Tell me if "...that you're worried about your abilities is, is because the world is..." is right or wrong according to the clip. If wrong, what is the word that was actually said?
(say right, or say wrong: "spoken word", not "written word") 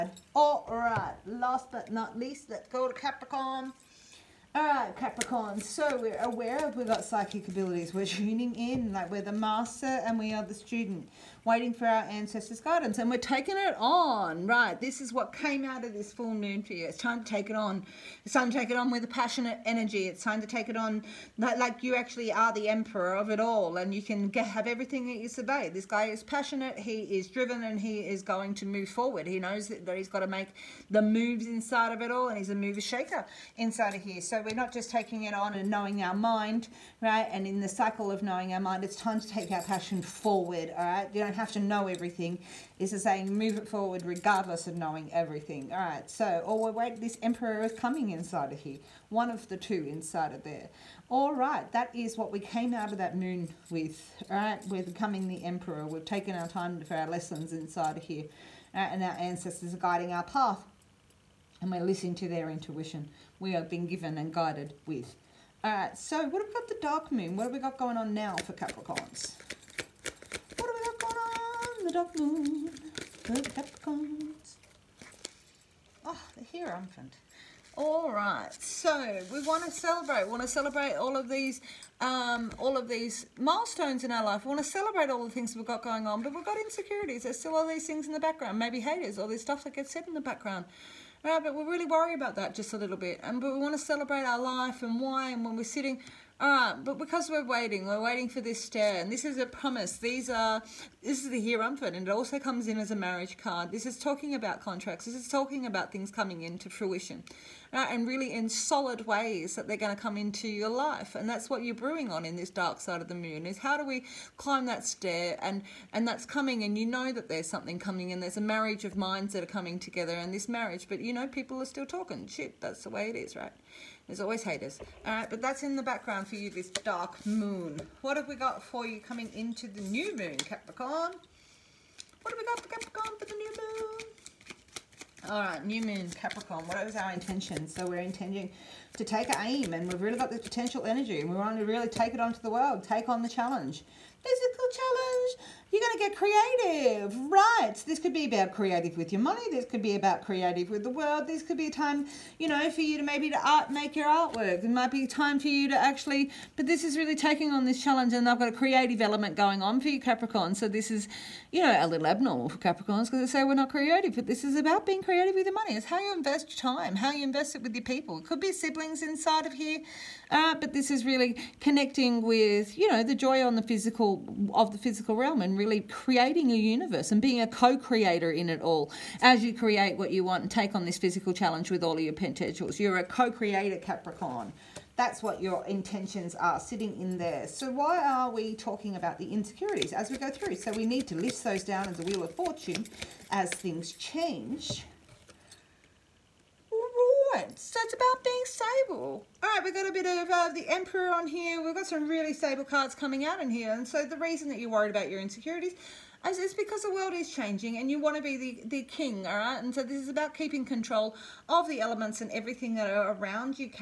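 wrong: "insecurities", not "abilities".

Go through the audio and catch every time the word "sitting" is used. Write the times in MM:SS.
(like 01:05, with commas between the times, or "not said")
01:35, 03:06.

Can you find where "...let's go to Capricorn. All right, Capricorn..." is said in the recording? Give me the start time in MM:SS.
00:02.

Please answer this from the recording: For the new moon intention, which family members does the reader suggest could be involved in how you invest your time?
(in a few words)
Siblings.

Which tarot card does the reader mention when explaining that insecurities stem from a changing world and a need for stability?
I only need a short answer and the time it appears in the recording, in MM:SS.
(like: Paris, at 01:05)
Wheel of Fortune, at 03:12.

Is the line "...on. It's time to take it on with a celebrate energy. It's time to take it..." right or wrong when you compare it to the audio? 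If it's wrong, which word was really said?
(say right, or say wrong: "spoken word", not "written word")
wrong: "passionate", not "celebrate".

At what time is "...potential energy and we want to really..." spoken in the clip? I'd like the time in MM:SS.
02:20.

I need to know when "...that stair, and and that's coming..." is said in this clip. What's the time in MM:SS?
01:54.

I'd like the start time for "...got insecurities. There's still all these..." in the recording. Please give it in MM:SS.
01:26.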